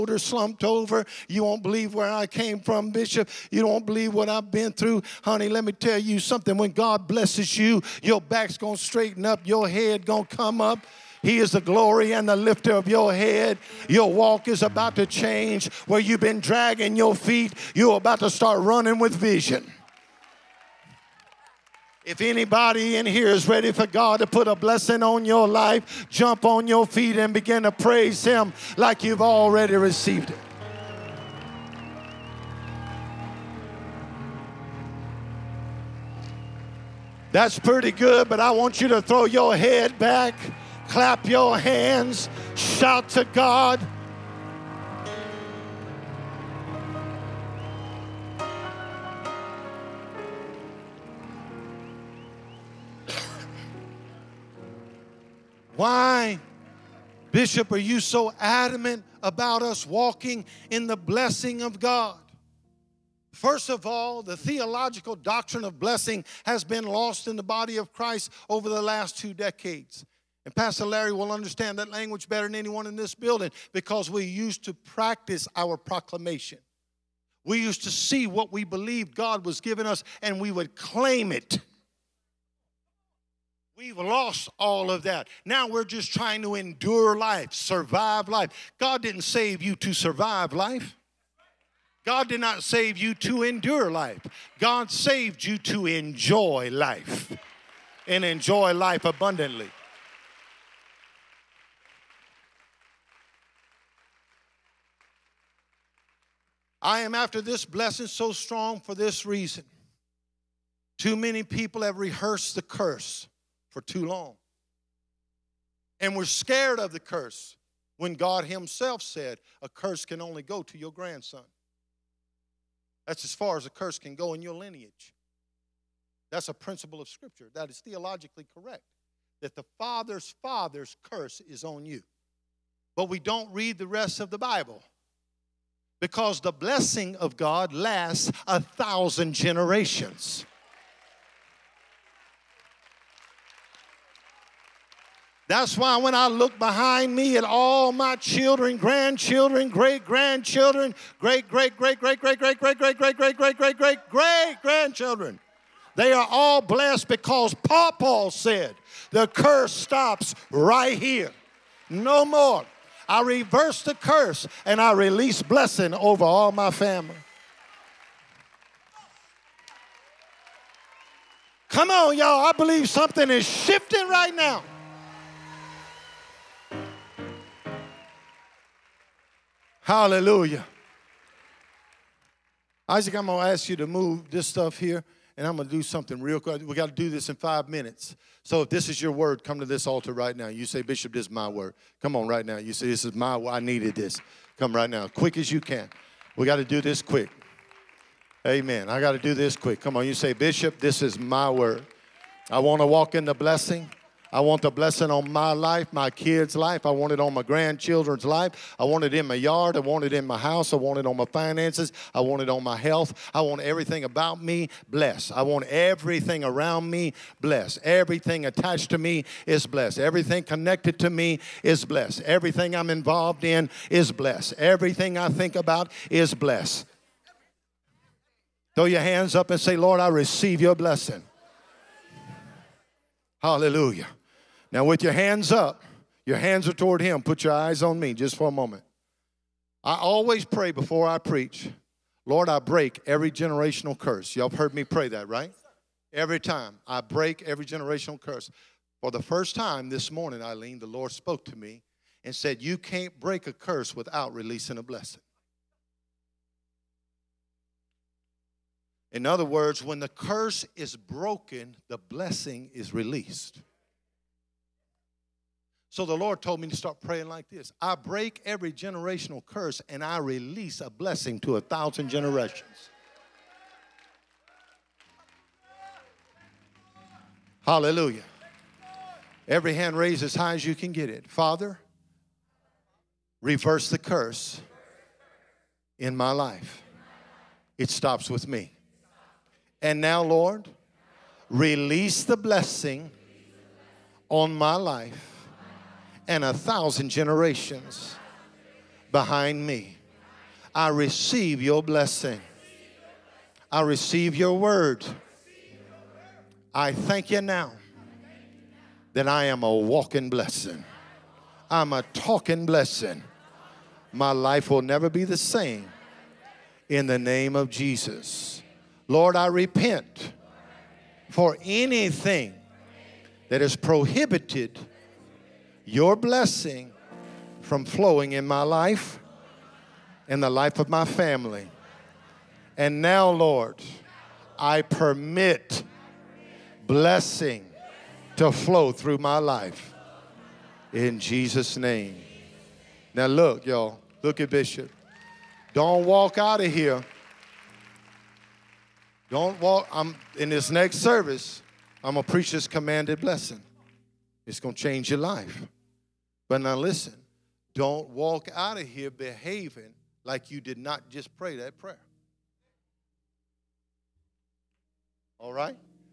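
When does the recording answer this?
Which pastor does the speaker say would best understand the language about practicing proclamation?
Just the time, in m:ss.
1:10.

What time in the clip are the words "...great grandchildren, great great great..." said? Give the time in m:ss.
2:29.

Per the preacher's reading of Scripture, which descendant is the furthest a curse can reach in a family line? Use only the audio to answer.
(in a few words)
grandson.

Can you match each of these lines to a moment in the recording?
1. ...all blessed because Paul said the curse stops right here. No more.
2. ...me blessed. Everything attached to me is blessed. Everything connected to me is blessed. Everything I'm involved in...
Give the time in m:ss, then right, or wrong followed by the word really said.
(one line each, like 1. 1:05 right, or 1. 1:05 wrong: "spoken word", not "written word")
1. 2:36 right
2. 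3:36 right.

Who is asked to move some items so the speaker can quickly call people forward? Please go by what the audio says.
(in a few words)
Isaac.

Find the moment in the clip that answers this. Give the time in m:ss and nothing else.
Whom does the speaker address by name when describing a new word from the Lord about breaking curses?
4:10.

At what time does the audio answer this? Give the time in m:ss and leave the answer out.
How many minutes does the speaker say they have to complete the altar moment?
3:07.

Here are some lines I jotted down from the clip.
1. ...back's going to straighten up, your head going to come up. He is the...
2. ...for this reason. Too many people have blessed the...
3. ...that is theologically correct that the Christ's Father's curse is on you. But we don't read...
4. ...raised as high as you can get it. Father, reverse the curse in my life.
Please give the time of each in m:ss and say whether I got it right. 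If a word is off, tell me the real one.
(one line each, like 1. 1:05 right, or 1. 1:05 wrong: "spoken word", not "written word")
1. 0:08 right
2. 1:48 wrong: "rehearsed", not "blessed"
3. 2:07 wrong: "Father", not "Christ"
4. 4:39 right.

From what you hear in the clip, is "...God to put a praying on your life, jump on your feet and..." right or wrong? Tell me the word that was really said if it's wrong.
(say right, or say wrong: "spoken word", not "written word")
wrong: "blessing", not "praying".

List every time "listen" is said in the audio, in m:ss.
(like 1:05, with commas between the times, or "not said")
5:56.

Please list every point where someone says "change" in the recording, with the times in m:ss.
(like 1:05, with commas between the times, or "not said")
0:15, 5:54.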